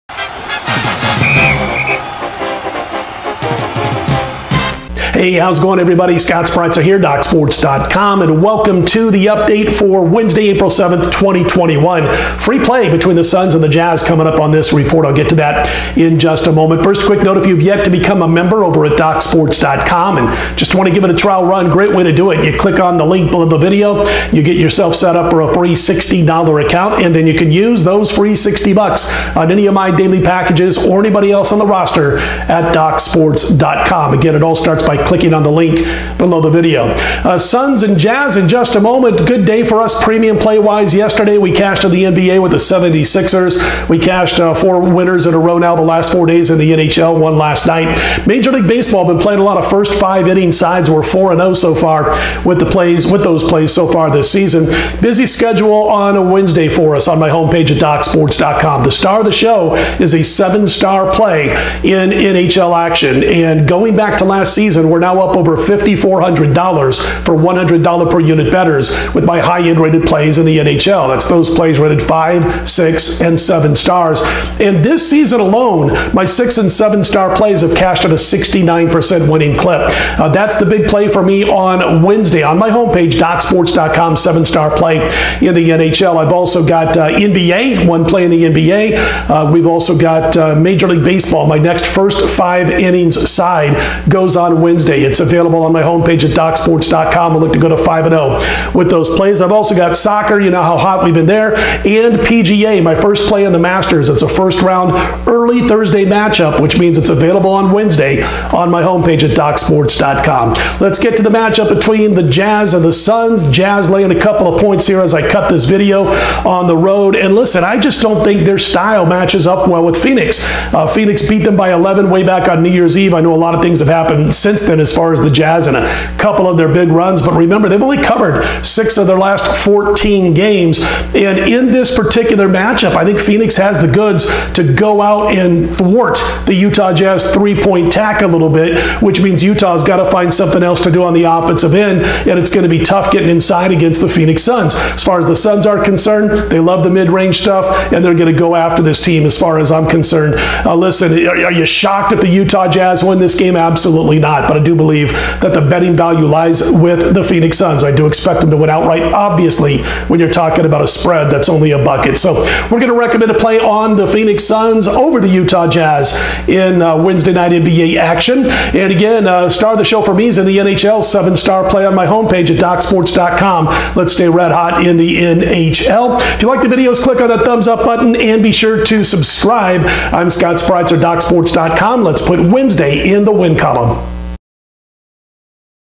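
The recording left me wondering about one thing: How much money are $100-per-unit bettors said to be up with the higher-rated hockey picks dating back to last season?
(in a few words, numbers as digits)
over $5,400.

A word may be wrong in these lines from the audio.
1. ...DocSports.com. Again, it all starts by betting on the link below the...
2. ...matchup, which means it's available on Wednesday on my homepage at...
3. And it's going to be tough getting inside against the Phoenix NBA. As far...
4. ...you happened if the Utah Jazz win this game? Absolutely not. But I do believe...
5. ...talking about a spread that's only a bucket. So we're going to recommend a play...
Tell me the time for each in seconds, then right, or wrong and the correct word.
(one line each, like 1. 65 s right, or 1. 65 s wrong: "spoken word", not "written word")
1. 32 s wrong: "clicking", not "betting"
2. 106 s right
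3. 142 s wrong: "Suns", not "NBA"
4. 151 s wrong: "shocked", not "happened"
5. 160 s right.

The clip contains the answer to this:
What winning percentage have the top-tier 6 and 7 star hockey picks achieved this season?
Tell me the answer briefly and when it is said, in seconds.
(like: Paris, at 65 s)
69%, at 78 s.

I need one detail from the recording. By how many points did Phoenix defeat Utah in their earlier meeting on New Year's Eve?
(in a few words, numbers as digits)
11.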